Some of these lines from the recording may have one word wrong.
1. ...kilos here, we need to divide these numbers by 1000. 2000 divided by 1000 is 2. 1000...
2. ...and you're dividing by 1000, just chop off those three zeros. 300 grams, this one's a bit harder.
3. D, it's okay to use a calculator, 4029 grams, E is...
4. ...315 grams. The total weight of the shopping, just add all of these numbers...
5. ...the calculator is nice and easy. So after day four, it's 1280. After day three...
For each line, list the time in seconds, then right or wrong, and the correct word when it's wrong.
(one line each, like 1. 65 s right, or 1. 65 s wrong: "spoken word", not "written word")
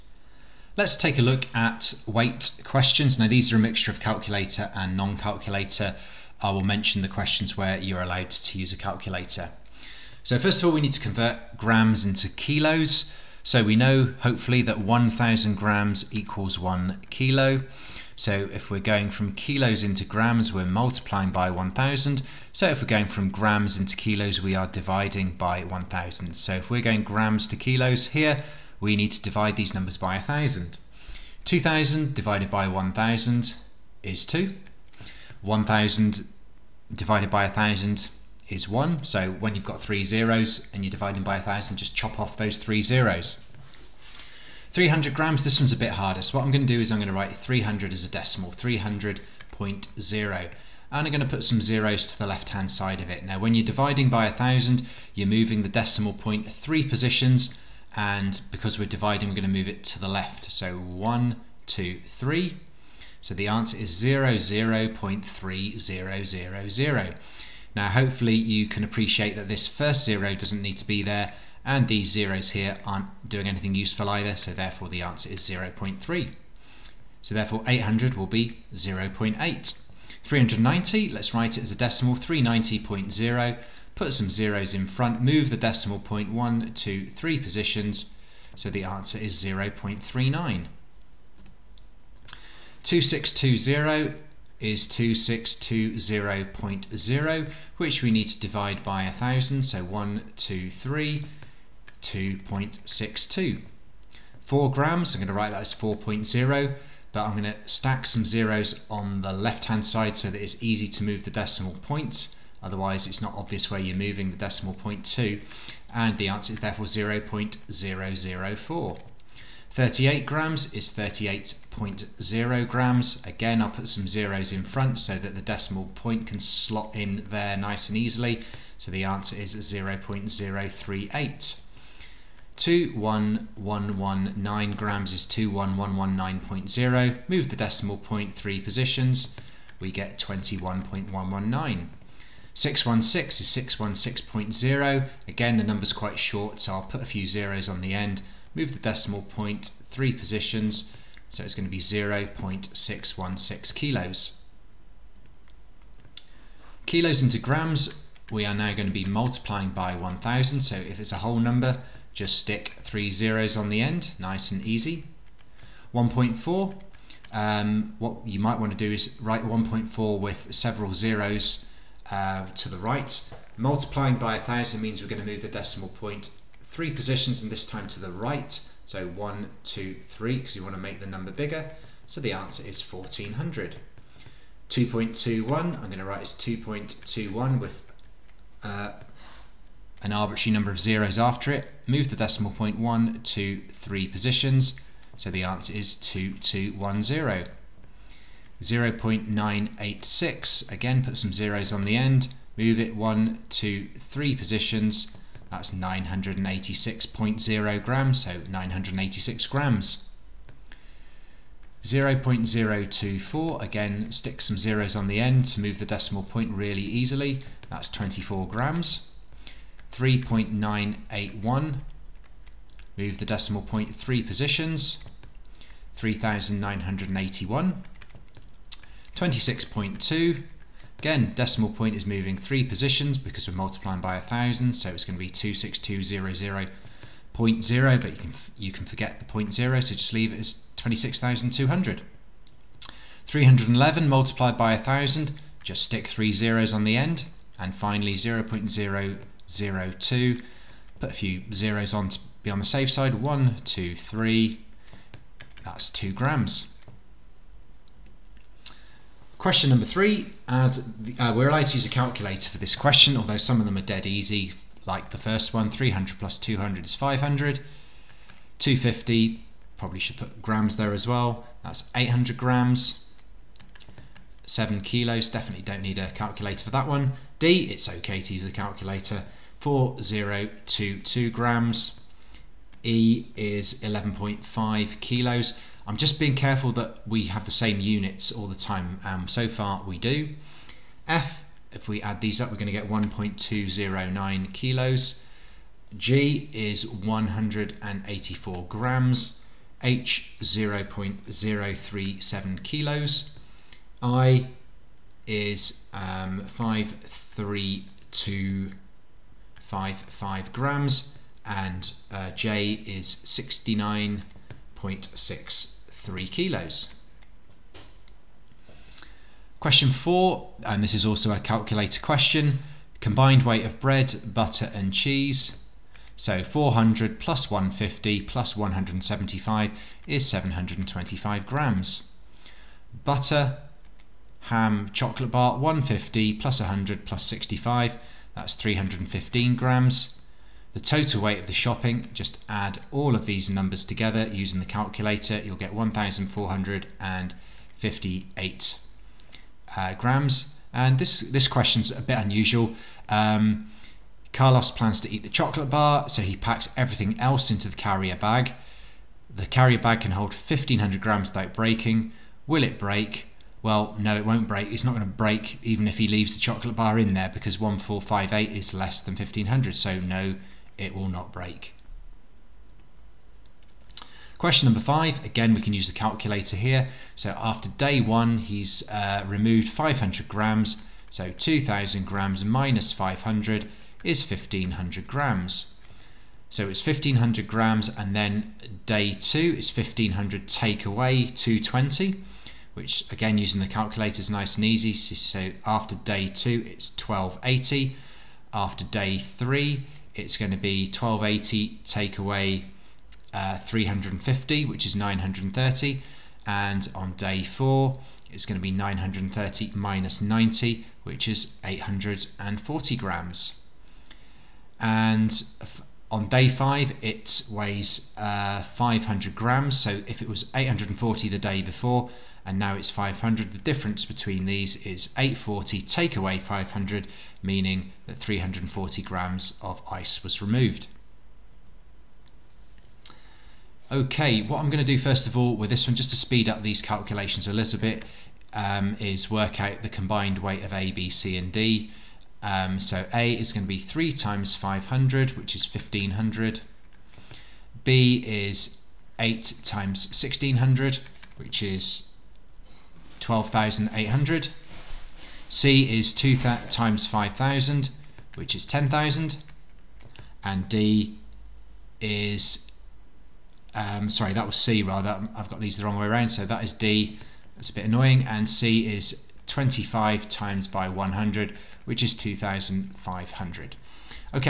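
1. 27 s right
2. 40 s right
3. 277 s wrong: "4022", not "4029"
4. 338 s right
5. 393 s wrong: "two", not "four".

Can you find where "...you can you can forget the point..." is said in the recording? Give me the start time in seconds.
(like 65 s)
238 s.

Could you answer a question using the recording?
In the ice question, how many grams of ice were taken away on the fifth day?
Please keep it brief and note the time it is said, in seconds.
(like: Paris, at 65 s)
340 grams, at 428 s.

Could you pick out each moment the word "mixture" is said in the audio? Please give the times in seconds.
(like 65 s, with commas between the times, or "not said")
3 s.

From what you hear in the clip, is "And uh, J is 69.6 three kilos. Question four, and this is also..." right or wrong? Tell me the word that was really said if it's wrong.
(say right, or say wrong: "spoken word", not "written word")
right.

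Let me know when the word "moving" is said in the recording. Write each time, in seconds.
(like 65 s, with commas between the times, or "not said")
55 s, 113 s, 232 s.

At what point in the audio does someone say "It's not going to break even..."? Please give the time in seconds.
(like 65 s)
364 s.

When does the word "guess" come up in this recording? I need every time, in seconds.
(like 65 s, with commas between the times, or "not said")
not said.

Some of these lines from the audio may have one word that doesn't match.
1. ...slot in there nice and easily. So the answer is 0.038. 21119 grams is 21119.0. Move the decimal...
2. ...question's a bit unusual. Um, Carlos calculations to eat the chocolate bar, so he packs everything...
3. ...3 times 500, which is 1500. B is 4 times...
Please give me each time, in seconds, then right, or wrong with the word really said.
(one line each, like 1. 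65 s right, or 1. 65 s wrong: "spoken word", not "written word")
1. 126 s right
2. 351 s wrong: "plans", not "calculations"
3. 443 s wrong: "8", not "4".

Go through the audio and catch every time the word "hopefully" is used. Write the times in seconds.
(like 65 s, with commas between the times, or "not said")
14 s, 67 s.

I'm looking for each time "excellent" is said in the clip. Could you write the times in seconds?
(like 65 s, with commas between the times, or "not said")
not said.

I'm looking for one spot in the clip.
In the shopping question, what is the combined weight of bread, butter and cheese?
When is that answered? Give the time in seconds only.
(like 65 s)
330 s.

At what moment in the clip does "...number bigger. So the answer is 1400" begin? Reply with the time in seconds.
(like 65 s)
181 s.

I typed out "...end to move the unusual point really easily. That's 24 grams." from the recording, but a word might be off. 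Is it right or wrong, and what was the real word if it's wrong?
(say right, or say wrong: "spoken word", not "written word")
wrong: "decimal", not "unusual".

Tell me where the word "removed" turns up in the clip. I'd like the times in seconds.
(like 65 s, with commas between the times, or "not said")
379 s, 430 s.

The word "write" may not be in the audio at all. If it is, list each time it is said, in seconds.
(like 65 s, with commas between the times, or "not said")
47 s, 81 s, 105 s, 169 s, 186 s.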